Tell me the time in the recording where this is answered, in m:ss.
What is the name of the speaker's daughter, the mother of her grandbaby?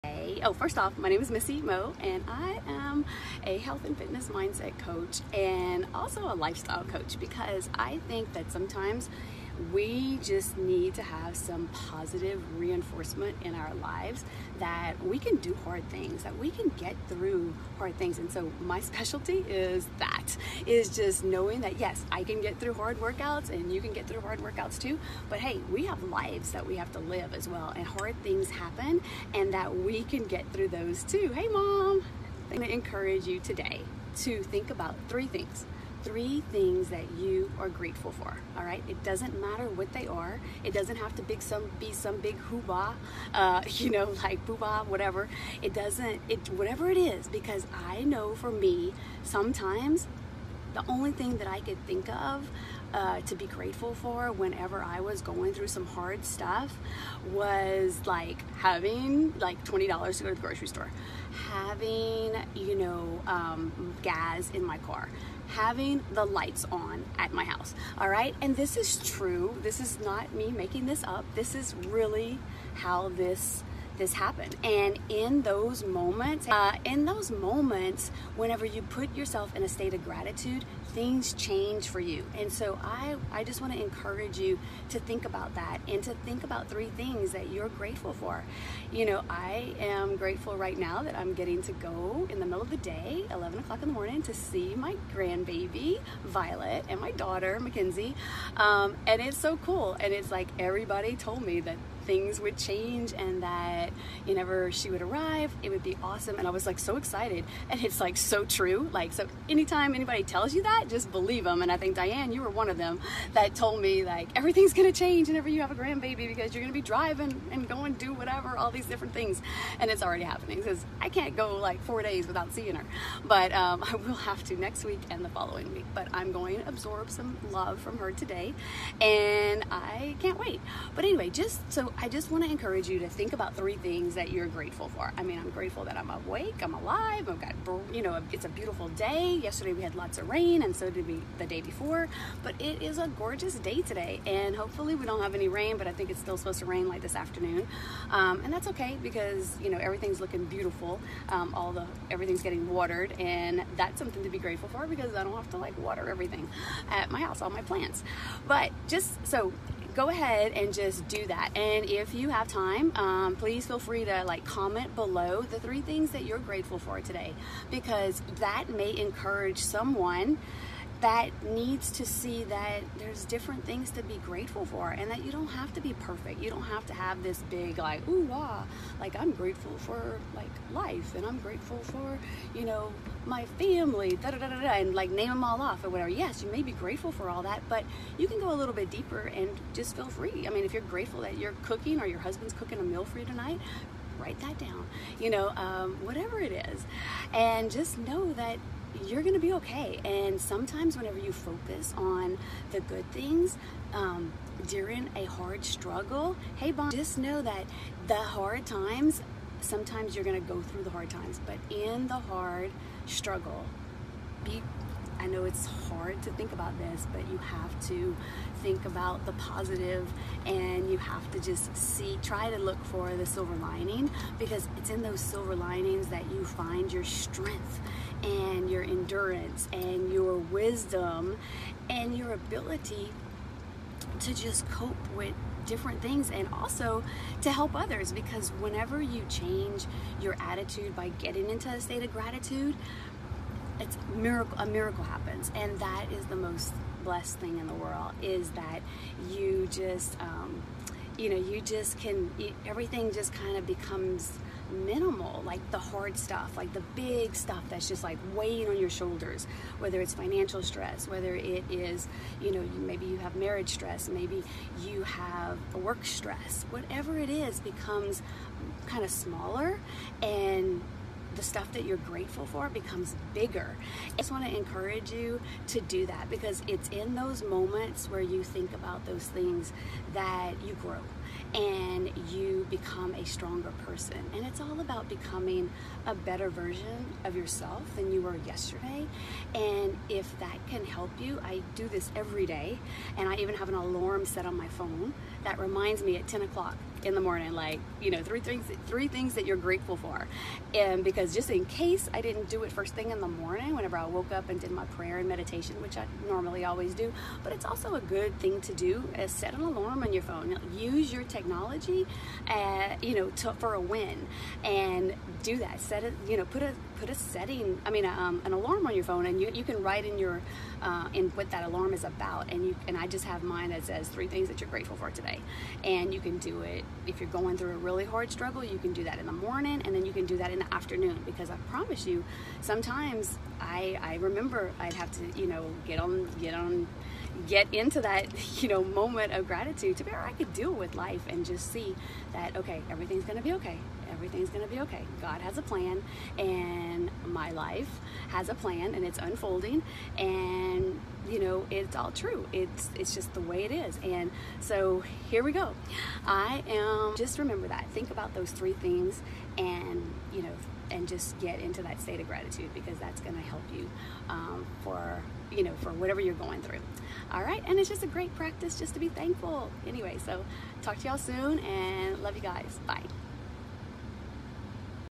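1:37.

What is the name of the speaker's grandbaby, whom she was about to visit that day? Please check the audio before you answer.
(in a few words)
Violet.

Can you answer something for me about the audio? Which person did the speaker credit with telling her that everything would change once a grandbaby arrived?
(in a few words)
Diane.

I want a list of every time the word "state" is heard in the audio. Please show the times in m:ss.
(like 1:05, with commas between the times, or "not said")
1:19, 4:01, 6:02.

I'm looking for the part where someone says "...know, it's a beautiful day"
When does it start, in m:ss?
2:18.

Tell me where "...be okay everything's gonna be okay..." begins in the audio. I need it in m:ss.
5:43.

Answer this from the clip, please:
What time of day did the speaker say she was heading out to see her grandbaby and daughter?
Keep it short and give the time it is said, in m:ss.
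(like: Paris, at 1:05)
11 o'clock, at 1:33.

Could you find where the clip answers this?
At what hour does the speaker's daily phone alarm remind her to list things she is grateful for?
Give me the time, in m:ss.
4:56.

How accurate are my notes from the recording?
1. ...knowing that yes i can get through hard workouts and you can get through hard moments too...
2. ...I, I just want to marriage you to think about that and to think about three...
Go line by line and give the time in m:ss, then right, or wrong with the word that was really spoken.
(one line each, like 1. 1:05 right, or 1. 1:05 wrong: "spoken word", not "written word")
1. 0:21 wrong: "workouts", not "moments"
2. 1:22 wrong: "encourage", not "marriage".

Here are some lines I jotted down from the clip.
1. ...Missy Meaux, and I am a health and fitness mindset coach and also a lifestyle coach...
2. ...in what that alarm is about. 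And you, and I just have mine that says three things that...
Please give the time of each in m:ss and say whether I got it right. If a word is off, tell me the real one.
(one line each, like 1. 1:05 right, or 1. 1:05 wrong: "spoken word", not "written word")
1. 0:01 right
2. 5:21 right.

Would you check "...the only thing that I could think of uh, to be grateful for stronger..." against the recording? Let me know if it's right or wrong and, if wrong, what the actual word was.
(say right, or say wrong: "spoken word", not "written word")
wrong: "whenever", not "stronger".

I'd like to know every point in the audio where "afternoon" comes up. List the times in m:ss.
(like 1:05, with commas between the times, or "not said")
2:27, 5:30.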